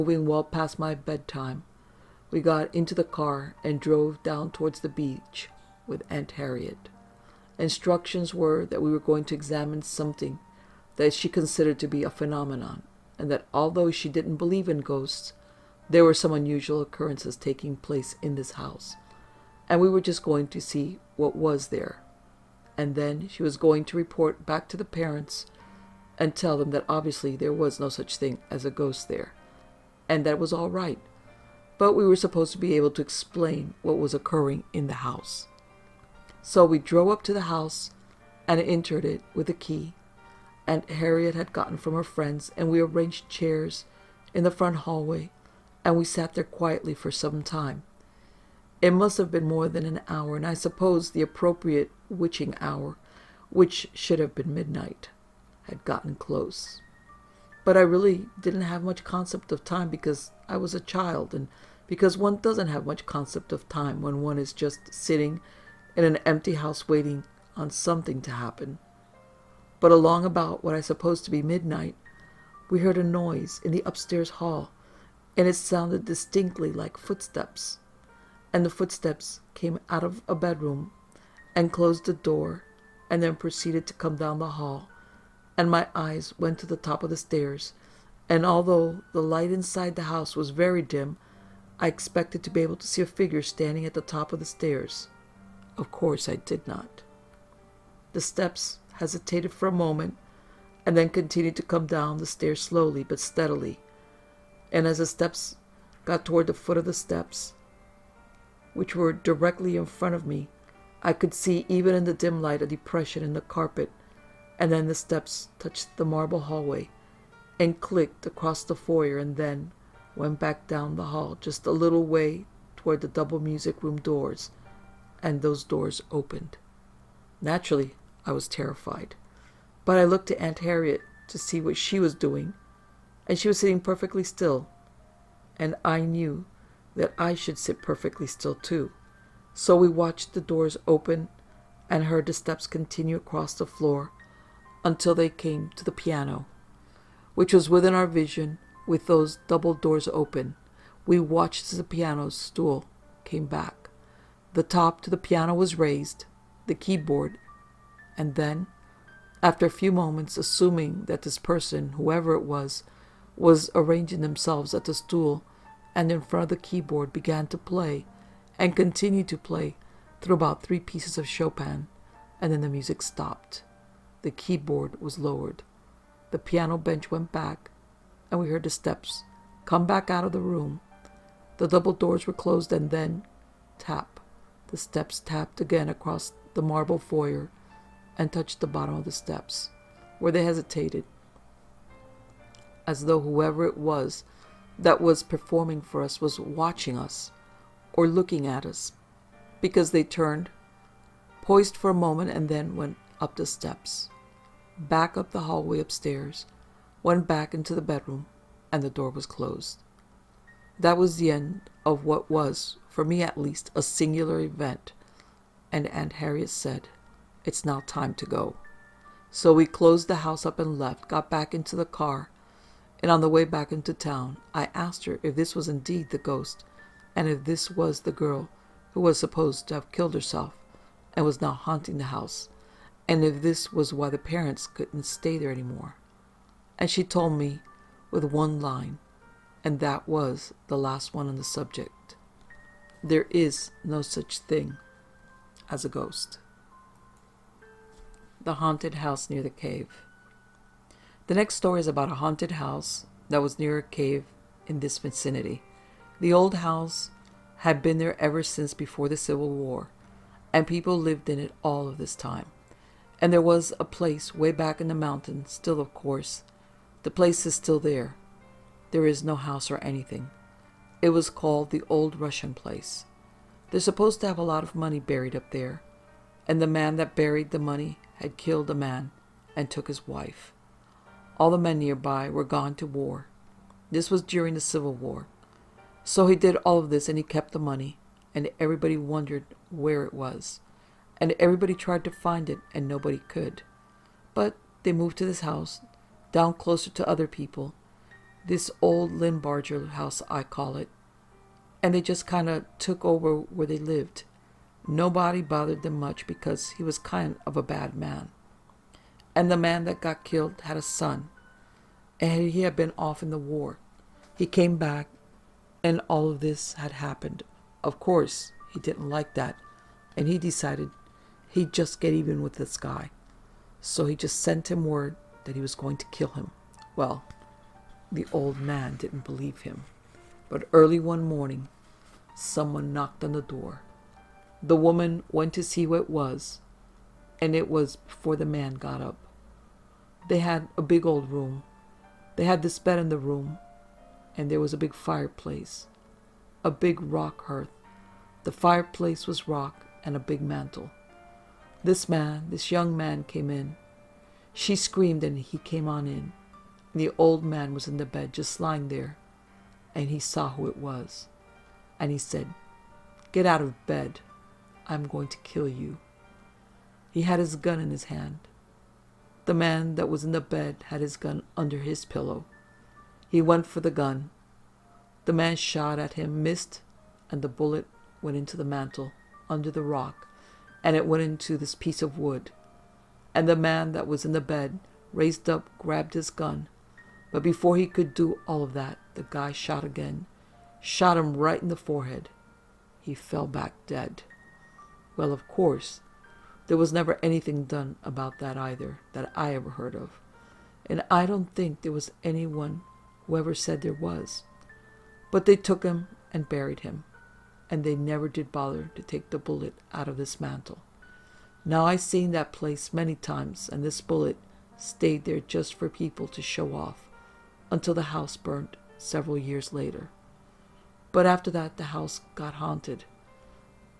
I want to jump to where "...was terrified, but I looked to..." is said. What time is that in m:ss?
2:08.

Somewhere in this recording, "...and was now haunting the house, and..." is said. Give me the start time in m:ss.
3:51.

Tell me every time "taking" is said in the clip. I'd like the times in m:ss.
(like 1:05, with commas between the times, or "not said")
0:17.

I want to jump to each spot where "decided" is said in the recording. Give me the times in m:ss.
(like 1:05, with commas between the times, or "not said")
5:20.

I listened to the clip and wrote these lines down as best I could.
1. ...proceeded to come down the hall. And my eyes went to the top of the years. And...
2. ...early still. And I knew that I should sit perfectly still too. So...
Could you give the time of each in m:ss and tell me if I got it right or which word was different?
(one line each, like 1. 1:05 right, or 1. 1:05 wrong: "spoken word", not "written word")
1. 1:23 wrong: "stairs", not "years"
2. 2:13 wrong: "perfectly", not "early".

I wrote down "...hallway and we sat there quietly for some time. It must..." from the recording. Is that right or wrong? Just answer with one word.
right.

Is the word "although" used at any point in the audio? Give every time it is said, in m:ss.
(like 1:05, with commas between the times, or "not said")
0:13, 1:28.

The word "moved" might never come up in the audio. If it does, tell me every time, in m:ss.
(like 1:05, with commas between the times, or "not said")
4:54.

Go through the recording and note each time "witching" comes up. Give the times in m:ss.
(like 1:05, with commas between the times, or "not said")
0:52.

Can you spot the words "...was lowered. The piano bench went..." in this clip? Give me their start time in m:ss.
2:55.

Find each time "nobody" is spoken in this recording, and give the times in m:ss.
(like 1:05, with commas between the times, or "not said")
4:52, 5:04.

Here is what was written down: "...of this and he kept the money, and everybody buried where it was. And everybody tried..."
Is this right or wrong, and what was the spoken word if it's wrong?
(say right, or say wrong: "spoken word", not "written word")
wrong: "wondered", not "buried".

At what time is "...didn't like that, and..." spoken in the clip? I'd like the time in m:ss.
5:18.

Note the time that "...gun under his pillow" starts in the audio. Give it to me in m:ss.
6:11.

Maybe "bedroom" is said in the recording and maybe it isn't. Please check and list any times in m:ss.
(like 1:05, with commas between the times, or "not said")
1:20, 3:27.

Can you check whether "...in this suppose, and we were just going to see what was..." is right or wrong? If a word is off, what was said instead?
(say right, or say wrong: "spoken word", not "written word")
wrong: "house", not "suppose".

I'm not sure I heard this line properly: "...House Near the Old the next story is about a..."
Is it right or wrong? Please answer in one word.
wrong.